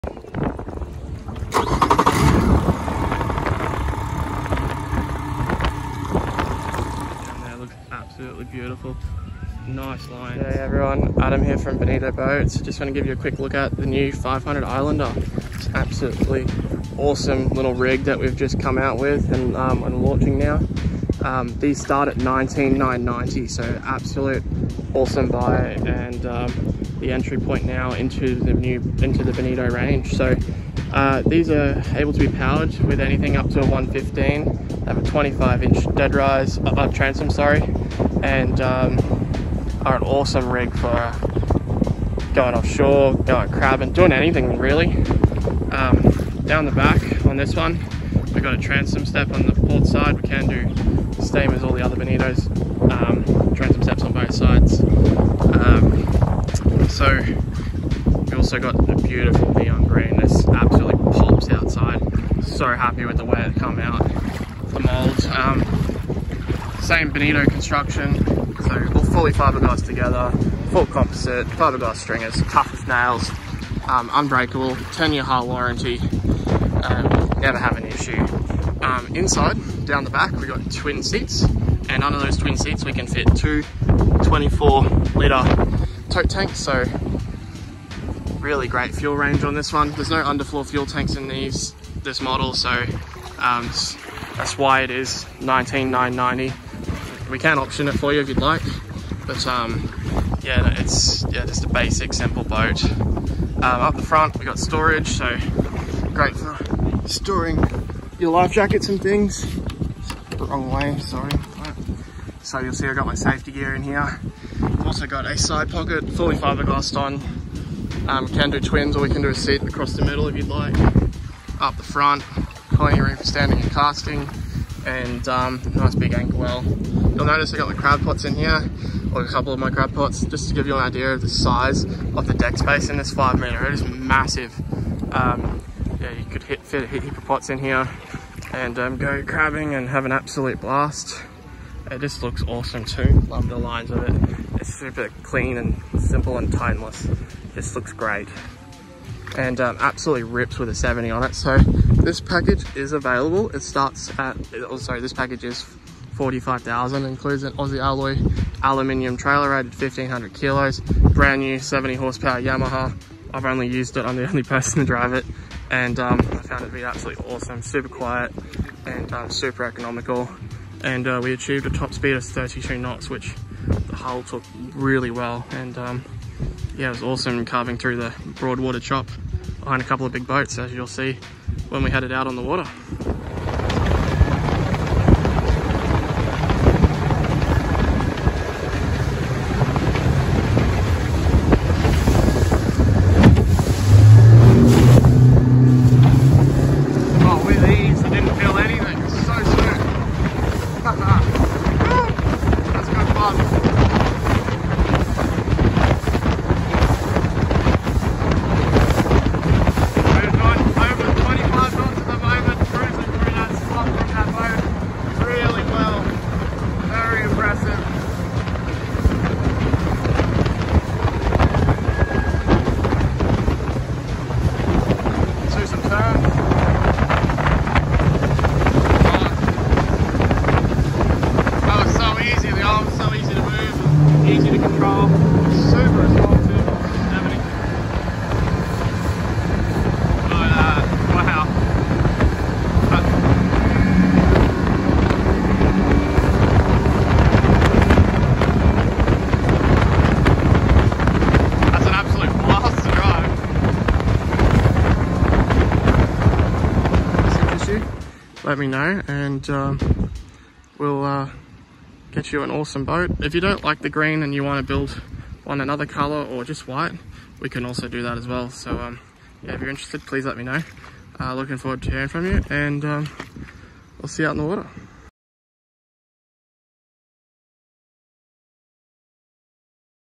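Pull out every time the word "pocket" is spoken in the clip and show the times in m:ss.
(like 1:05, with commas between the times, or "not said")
1:55.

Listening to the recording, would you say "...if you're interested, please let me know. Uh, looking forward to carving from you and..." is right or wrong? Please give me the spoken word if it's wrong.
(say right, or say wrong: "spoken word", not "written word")
wrong: "hearing", not "carving".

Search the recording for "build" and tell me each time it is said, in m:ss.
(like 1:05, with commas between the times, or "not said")
4:24.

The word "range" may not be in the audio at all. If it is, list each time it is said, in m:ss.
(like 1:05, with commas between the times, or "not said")
0:29, 1:29.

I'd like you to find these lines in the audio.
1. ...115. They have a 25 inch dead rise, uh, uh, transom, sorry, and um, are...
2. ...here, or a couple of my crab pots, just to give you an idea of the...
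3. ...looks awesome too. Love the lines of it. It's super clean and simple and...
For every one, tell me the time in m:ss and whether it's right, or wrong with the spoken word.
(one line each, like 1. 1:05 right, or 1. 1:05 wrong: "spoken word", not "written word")
1. 0:33 right
2. 2:08 right
3. 2:22 right.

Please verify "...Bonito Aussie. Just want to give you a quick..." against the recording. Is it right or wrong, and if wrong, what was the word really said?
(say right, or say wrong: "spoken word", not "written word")
wrong: "Boats", not "Aussie".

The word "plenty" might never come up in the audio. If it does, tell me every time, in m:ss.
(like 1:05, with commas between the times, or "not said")
2:02.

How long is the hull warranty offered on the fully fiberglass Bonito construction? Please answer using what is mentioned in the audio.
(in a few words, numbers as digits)
10 years.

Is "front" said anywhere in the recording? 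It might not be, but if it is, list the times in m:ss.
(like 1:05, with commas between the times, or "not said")
1:44, 2:01.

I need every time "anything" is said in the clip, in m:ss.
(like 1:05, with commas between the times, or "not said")
0:32, 0:44.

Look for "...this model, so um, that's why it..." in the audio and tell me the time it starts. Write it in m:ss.
1:32.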